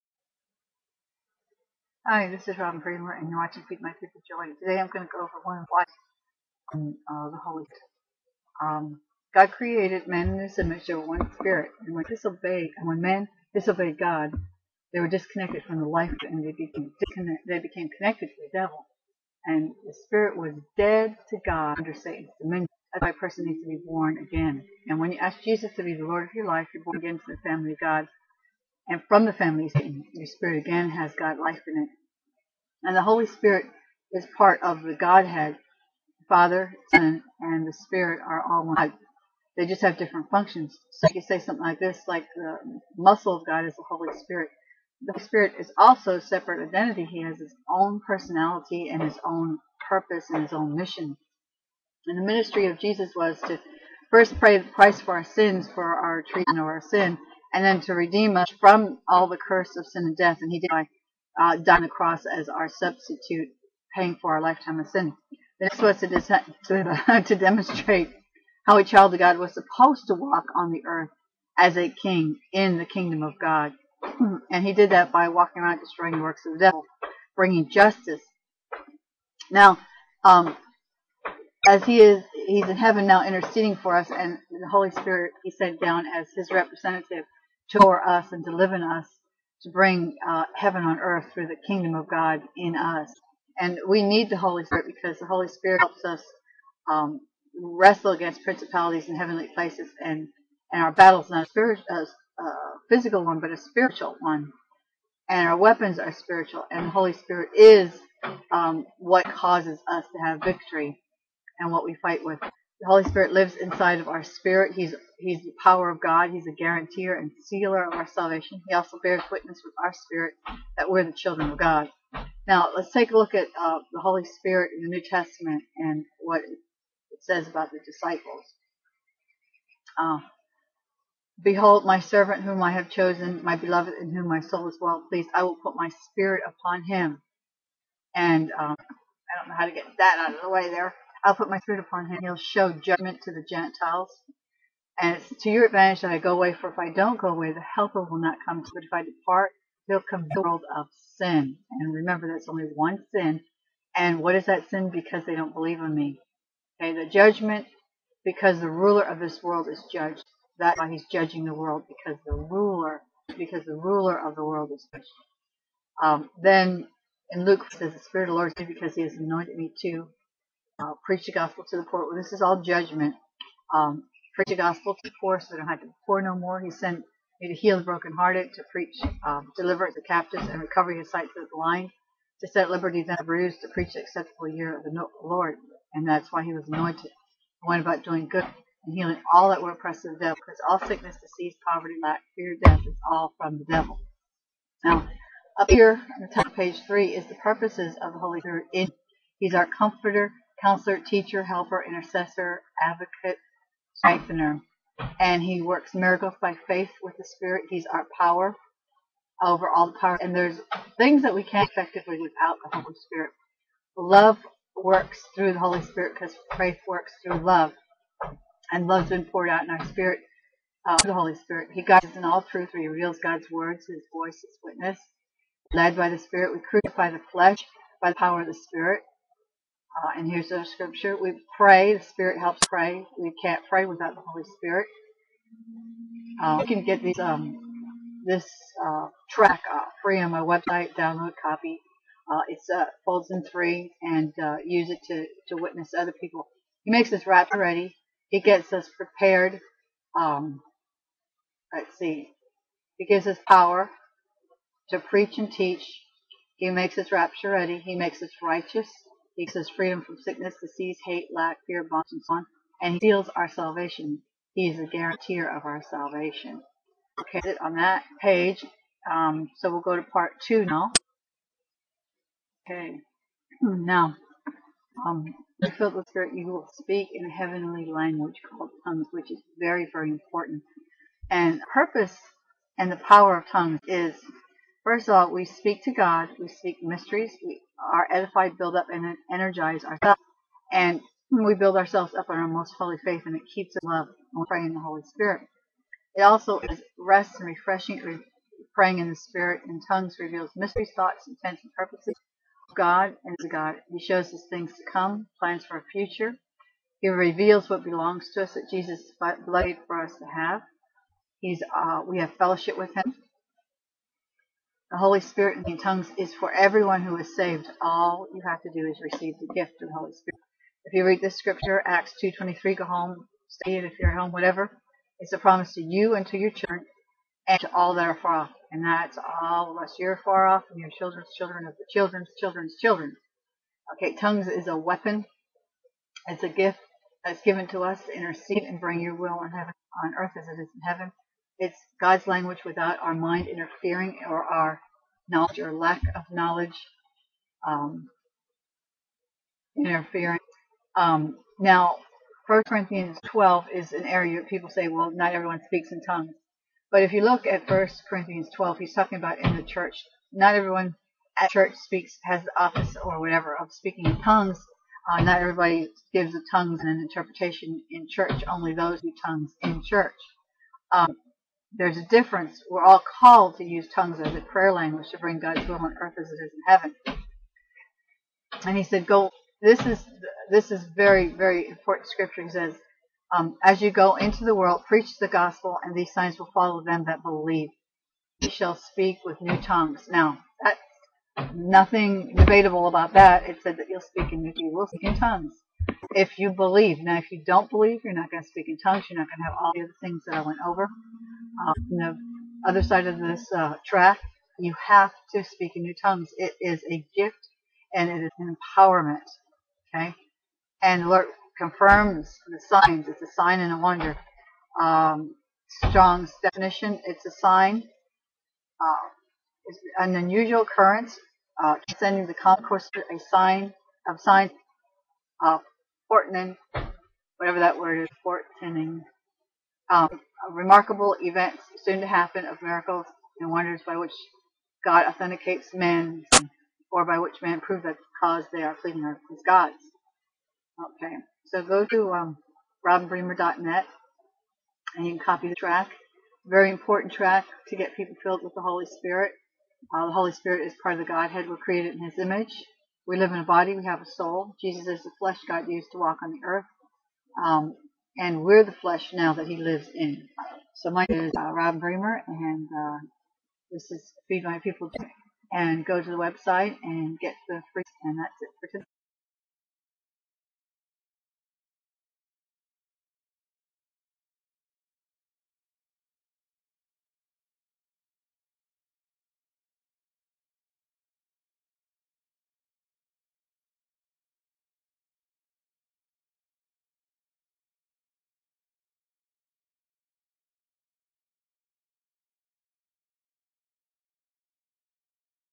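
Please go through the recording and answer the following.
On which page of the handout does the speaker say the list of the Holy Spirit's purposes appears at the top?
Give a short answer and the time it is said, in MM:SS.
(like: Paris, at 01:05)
Page 3, at 03:16.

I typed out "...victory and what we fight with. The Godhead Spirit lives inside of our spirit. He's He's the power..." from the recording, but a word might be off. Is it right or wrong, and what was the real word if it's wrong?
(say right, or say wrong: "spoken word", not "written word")
wrong: "Holy", not "Godhead".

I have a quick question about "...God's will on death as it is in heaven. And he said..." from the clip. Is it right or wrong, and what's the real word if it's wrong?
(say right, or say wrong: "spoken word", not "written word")
wrong: "earth", not "death".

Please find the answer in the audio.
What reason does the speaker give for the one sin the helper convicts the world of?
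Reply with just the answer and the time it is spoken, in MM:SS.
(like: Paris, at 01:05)
They don't believe in me, at 02:35.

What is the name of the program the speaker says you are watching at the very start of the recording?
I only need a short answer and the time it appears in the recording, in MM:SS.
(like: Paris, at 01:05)
Feed My People Joy, at 00:03.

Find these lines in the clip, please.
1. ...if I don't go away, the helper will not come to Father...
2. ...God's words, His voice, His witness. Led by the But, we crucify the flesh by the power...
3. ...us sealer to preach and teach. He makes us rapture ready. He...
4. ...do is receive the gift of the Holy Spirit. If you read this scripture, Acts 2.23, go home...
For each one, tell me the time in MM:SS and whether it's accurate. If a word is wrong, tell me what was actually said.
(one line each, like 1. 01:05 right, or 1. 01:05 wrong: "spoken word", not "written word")
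1. 02:26 wrong: "But", not "Father"
2. 03:43 wrong: "Spirit", not "But"
3. 04:13 wrong: "power", not "sealer"
4. 05:18 right.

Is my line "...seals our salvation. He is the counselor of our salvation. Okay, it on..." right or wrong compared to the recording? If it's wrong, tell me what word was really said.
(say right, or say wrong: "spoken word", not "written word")
wrong: "guarantor", not "counselor".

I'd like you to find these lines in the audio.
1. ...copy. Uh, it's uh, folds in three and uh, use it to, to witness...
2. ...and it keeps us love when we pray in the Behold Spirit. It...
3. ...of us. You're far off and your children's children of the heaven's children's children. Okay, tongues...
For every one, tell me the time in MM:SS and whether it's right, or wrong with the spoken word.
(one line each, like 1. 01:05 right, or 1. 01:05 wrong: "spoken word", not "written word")
1. 04:01 right
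2. 04:53 wrong: "Holy", not "Behold"
3. 05:29 wrong: "children", not "heaven".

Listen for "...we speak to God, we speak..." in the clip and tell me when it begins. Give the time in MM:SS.
04:45.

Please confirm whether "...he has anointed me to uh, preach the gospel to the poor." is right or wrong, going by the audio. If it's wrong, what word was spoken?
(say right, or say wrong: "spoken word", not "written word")
right.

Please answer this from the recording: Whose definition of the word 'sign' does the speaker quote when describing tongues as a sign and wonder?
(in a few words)
Strong's.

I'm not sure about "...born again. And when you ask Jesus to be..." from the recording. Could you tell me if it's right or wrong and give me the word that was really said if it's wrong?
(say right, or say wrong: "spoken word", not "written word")
right.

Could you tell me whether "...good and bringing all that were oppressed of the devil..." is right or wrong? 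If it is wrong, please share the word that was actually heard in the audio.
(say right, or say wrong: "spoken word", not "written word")
wrong: "healing", not "bringing".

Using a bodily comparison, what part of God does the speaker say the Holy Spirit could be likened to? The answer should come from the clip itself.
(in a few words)
The muscle.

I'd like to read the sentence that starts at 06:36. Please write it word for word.
Now, if you don't believe, you're not going to speak in tongues.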